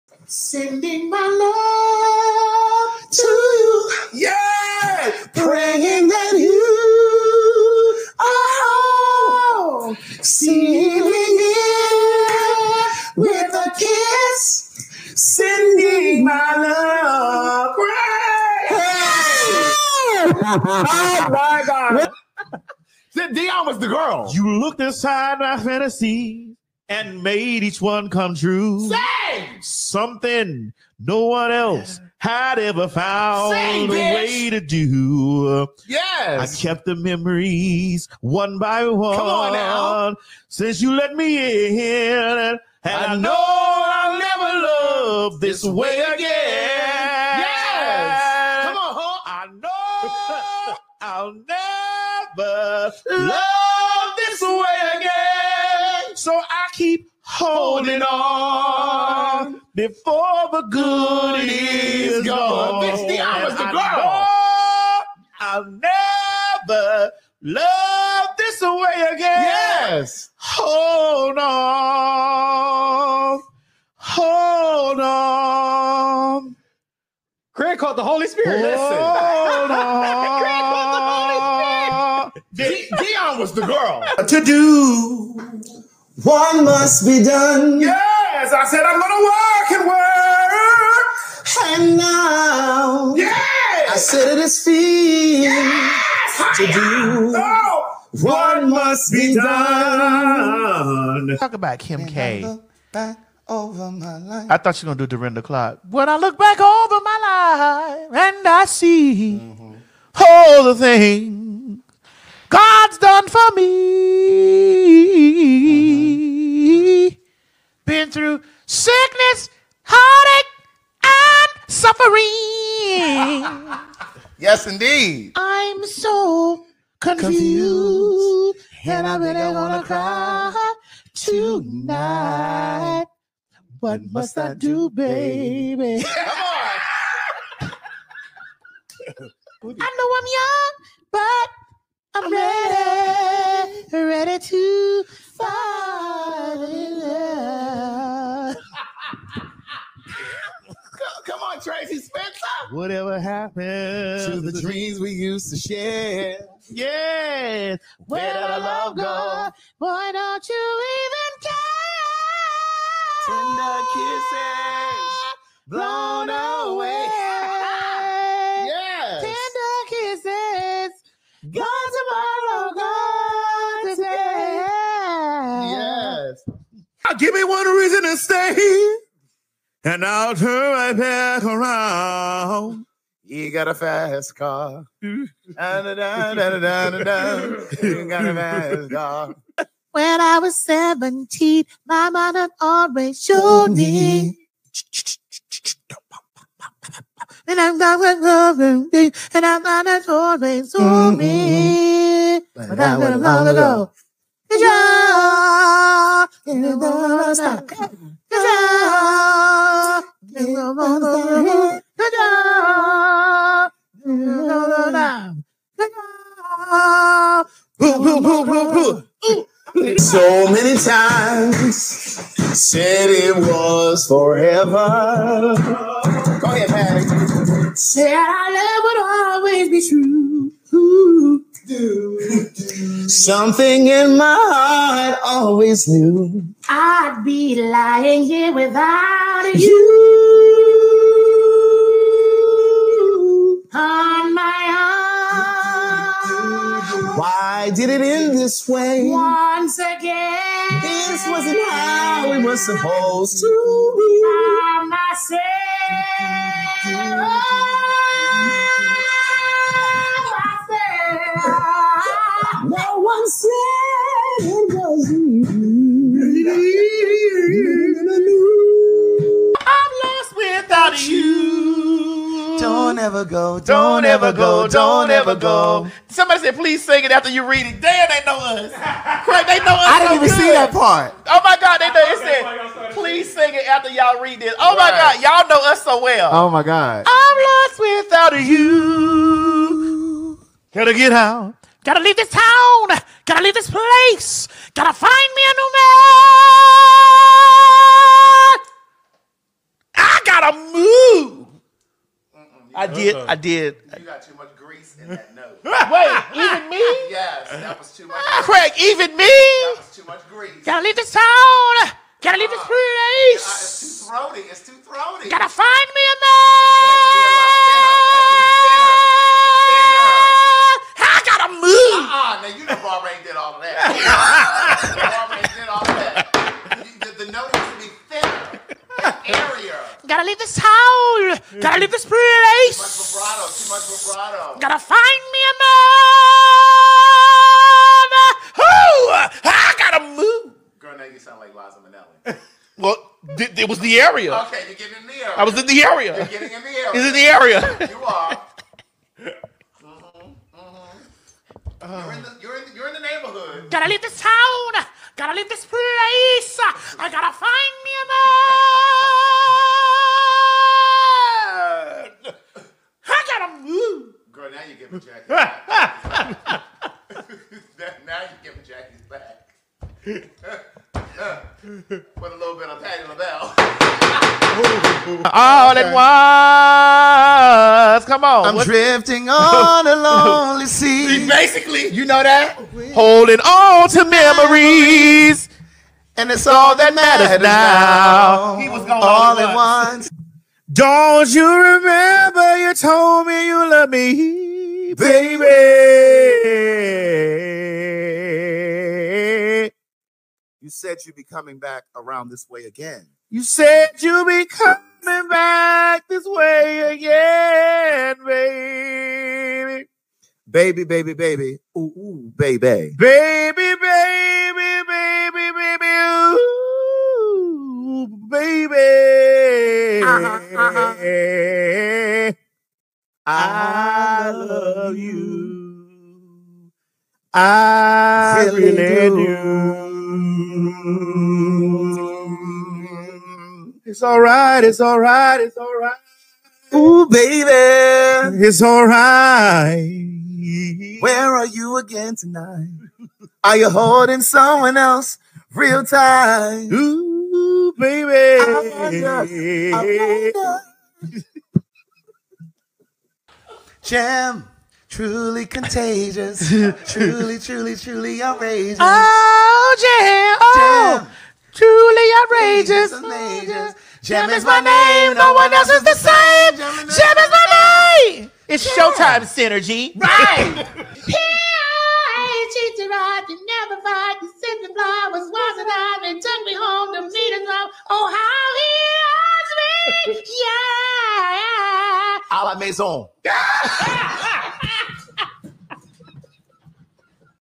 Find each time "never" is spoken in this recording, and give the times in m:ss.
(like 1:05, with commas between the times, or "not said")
0:44, 0:52, 1:05, 7:53.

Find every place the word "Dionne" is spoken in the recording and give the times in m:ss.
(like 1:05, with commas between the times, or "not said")
0:23, 1:23.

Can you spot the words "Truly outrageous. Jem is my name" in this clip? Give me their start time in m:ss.
7:41.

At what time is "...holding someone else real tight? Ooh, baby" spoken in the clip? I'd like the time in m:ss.
7:23.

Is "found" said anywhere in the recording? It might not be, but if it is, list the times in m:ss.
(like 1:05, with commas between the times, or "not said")
0:32.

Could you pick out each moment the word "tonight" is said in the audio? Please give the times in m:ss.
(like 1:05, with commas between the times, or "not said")
2:11, 7:22.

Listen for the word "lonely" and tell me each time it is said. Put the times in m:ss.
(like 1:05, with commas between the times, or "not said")
6:19.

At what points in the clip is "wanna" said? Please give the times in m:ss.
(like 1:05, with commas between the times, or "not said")
2:09.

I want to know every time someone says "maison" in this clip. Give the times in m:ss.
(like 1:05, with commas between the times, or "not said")
8:02.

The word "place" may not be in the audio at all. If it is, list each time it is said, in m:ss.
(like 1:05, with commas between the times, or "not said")
4:53, 5:12, 5:32, 5:55.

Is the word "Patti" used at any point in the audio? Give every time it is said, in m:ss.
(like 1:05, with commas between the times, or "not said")
3:46, 6:12.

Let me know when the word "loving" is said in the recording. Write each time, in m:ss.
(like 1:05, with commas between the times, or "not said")
3:18.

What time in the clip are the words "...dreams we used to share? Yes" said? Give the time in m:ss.
2:34.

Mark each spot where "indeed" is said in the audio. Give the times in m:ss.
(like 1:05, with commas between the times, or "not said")
2:04.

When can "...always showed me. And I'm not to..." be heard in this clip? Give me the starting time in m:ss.
3:12.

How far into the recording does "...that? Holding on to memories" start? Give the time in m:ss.
6:22.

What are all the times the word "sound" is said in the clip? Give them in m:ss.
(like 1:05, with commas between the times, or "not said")
5:41.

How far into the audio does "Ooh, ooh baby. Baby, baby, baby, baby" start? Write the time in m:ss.
6:51.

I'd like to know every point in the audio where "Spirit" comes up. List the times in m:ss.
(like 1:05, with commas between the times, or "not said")
1:18, 1:22.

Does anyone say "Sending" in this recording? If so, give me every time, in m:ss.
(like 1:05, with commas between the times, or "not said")
0:00, 0:15.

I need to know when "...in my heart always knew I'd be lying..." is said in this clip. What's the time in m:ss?
3:53.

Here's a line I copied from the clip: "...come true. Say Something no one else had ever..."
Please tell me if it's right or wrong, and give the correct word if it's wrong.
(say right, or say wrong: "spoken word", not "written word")
right.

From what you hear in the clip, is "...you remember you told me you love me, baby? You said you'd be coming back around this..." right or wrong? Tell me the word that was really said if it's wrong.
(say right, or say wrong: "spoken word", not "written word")
right.